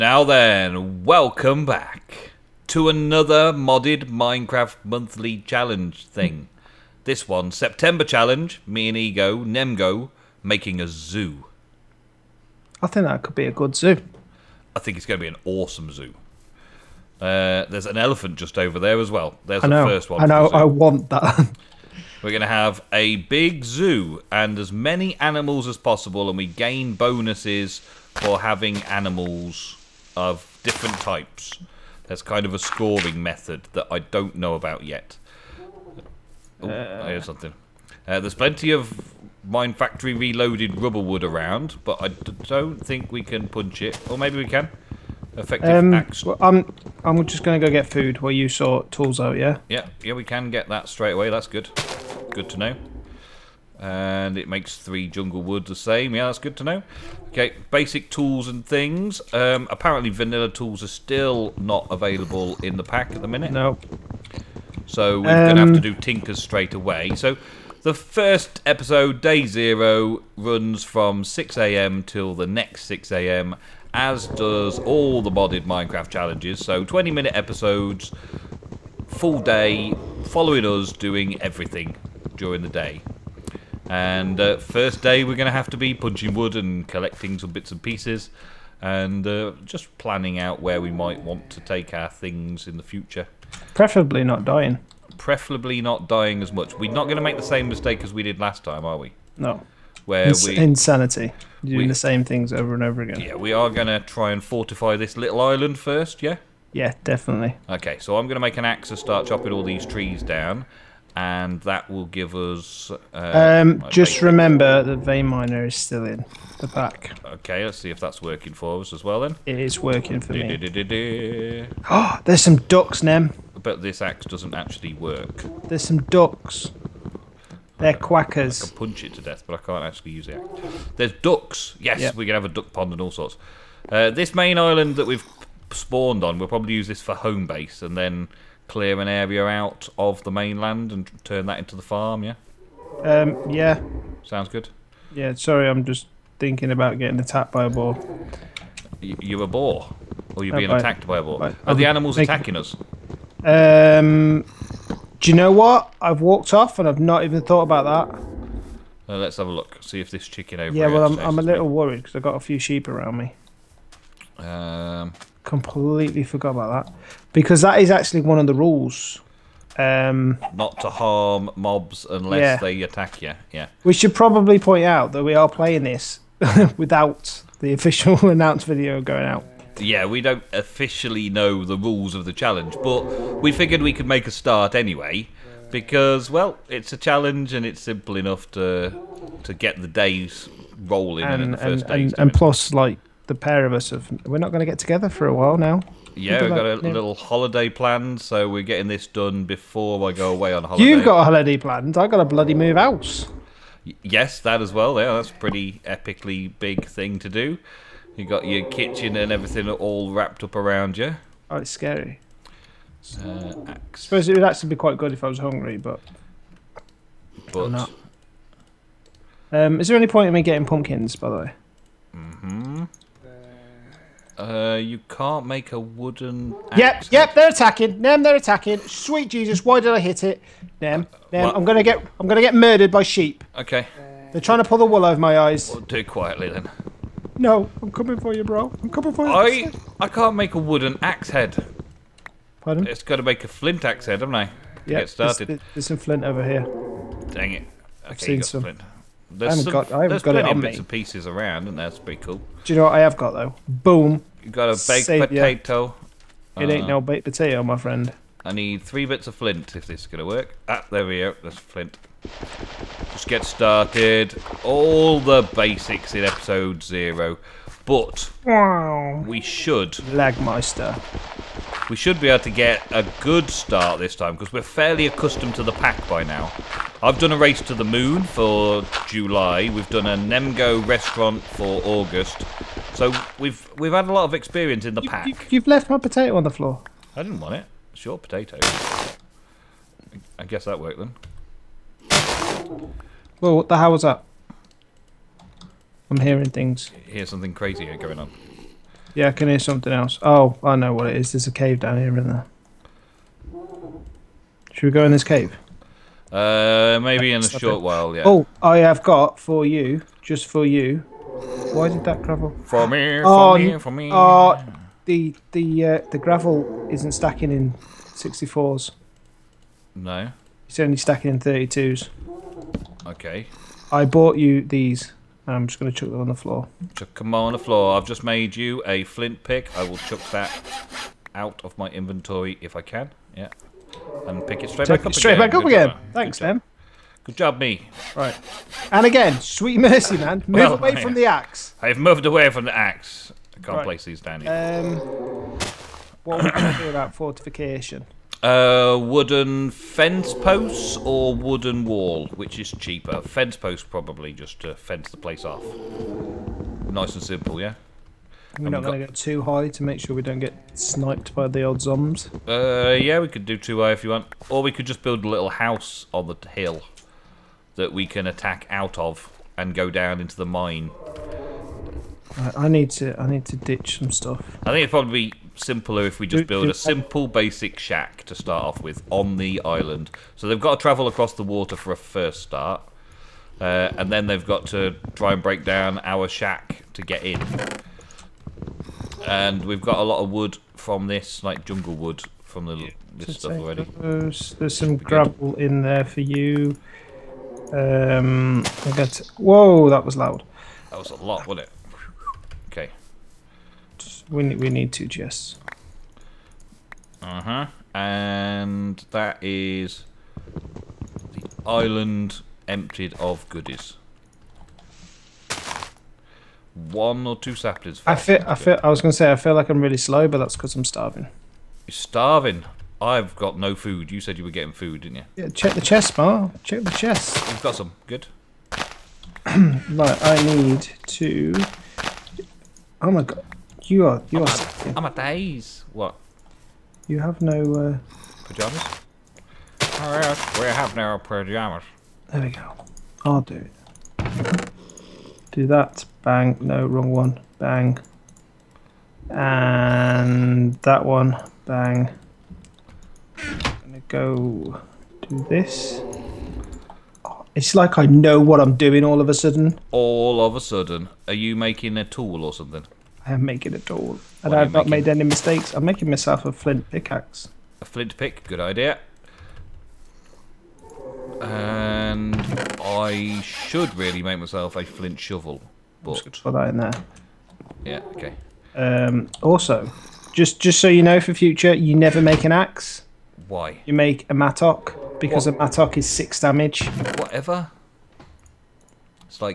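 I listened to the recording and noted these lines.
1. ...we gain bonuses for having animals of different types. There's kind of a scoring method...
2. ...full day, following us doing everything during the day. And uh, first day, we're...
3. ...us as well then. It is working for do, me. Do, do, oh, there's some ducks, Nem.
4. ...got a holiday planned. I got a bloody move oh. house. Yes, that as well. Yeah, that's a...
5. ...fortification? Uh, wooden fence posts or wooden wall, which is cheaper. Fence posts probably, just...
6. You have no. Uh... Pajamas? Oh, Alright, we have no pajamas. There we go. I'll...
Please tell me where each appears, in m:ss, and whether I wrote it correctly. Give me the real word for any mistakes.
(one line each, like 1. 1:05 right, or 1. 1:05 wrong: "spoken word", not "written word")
1. 0:26 right
2. 1:19 right
3. 1:58 right
4. 3:21 right
5. 5:47 right
6. 7:17 right.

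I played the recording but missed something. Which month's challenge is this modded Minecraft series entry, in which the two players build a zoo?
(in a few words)
September.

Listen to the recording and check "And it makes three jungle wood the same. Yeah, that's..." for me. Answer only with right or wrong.
right.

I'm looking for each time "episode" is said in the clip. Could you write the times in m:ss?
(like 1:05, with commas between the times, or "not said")
1:08, 1:17, 4:26.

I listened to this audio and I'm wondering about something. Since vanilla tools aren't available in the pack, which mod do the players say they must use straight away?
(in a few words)
Tinkers.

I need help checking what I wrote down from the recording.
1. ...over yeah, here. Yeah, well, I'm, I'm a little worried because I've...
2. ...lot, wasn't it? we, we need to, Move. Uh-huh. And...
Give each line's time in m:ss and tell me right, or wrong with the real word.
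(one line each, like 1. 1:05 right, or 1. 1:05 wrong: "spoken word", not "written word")
1. 2:40 right
2. 6:41 wrong: "Jess", not "Move".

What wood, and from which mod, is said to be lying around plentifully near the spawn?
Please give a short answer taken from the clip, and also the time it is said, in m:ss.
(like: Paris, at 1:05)
Mine Factory Reloaded rubber wood, at 0:39.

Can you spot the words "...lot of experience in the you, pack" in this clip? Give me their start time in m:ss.
4:44.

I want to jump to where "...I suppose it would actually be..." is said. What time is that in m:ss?
3:33.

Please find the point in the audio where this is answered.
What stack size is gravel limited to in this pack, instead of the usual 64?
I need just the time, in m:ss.
5:21.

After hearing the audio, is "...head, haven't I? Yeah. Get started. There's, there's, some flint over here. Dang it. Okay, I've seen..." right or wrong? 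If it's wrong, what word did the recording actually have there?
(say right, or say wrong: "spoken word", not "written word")
right.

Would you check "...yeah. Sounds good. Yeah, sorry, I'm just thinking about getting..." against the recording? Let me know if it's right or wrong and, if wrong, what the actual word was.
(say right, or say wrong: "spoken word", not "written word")
right.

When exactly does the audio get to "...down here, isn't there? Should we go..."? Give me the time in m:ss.
5:01.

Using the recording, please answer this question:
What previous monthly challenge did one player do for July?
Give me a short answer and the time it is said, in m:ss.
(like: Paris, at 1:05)
Race to the moon, at 4:37.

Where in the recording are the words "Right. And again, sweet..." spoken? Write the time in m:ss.
5:38.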